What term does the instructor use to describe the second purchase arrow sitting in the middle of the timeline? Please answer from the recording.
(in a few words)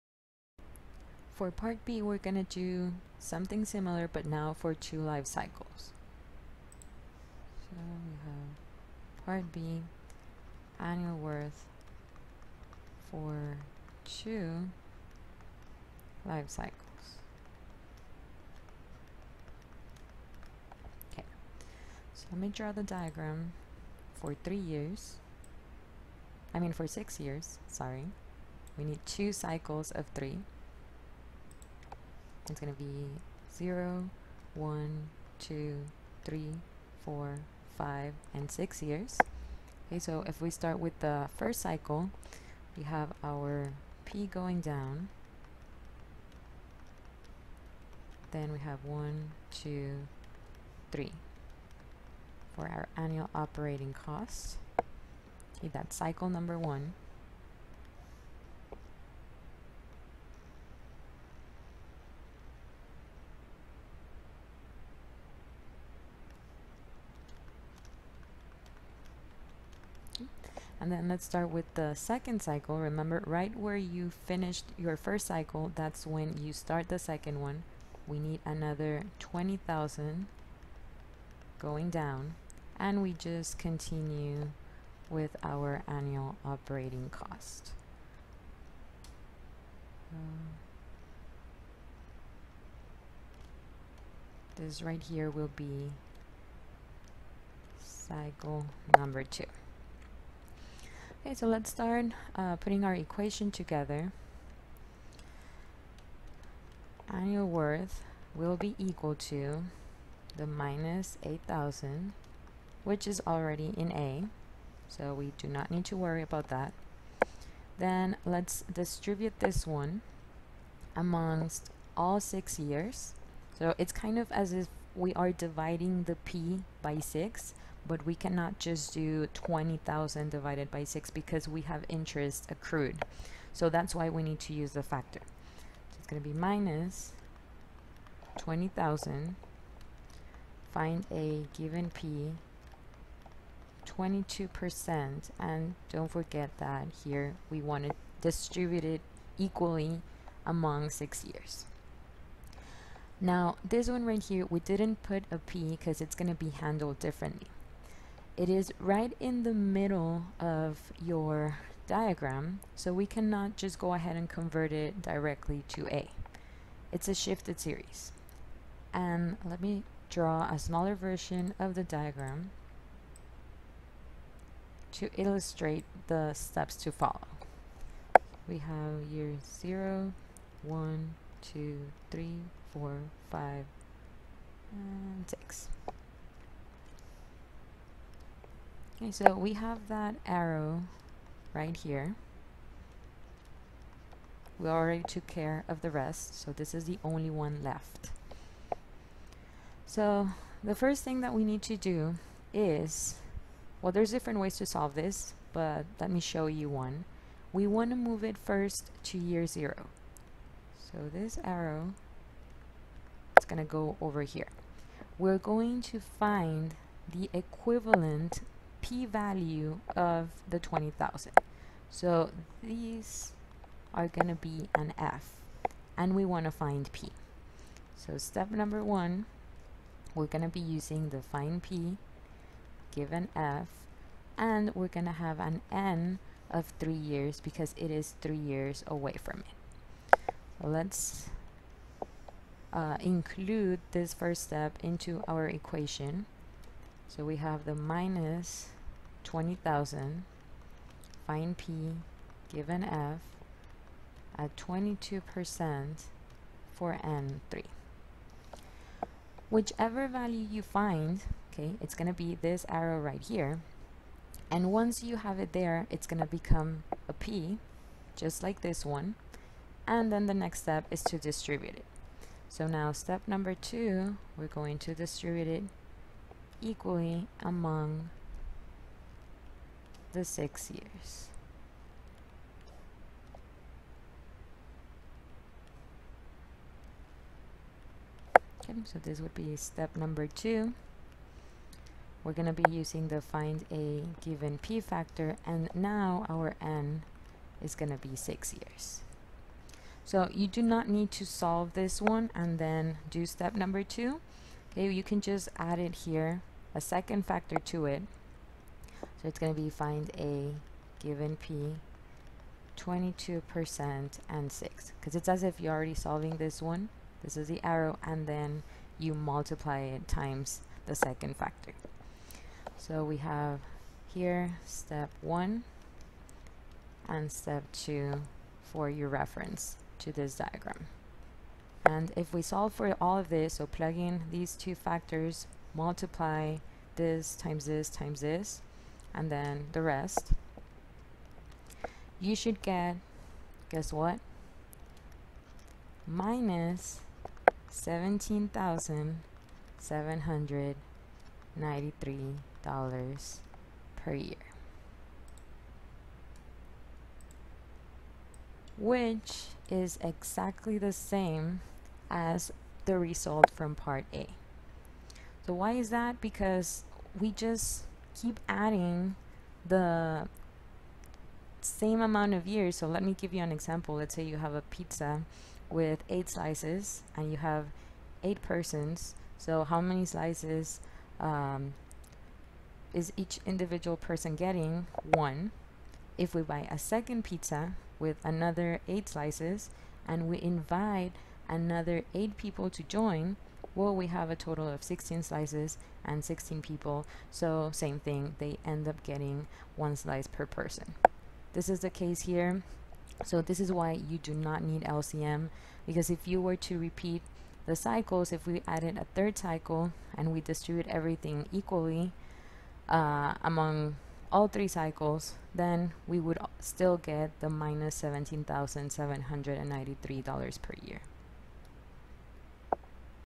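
shifted series.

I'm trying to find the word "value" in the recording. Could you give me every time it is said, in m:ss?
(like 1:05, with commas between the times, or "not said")
3:38, 4:20.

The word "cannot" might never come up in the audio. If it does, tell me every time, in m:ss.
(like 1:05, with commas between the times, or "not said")
2:08, 2:43.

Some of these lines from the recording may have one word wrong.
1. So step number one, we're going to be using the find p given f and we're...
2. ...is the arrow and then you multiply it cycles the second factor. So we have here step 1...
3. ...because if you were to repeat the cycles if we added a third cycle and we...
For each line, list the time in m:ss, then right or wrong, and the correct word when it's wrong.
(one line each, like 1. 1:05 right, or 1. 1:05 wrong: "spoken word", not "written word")
1. 3:47 right
2. 5:17 wrong: "times", not "cycles"
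3. 6:45 right.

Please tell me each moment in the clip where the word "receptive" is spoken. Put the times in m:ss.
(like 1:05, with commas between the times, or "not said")
not said.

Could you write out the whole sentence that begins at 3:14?
We already took care of the rest, so this is the only one left.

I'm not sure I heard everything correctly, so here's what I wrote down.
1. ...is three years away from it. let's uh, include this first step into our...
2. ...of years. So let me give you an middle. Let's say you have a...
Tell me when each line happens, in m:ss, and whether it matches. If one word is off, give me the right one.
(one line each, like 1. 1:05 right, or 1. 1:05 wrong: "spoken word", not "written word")
1. 3:57 right
2. 6:12 wrong: "example", not "middle".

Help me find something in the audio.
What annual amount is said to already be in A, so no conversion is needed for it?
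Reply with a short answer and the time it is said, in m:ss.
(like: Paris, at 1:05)
-8,000, at 1:50.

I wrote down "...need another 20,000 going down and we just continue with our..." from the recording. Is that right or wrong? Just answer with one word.
right.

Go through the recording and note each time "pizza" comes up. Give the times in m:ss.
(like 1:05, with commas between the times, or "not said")
6:14, 6:27.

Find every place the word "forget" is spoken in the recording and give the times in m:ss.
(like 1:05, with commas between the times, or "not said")
2:26.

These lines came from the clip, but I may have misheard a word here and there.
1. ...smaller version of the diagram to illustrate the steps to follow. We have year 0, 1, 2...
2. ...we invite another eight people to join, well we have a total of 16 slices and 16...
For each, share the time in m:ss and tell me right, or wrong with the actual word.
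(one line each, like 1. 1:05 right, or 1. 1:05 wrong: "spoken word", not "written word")
1. 2:50 right
2. 6:30 right.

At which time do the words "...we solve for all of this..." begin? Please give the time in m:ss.
5:32.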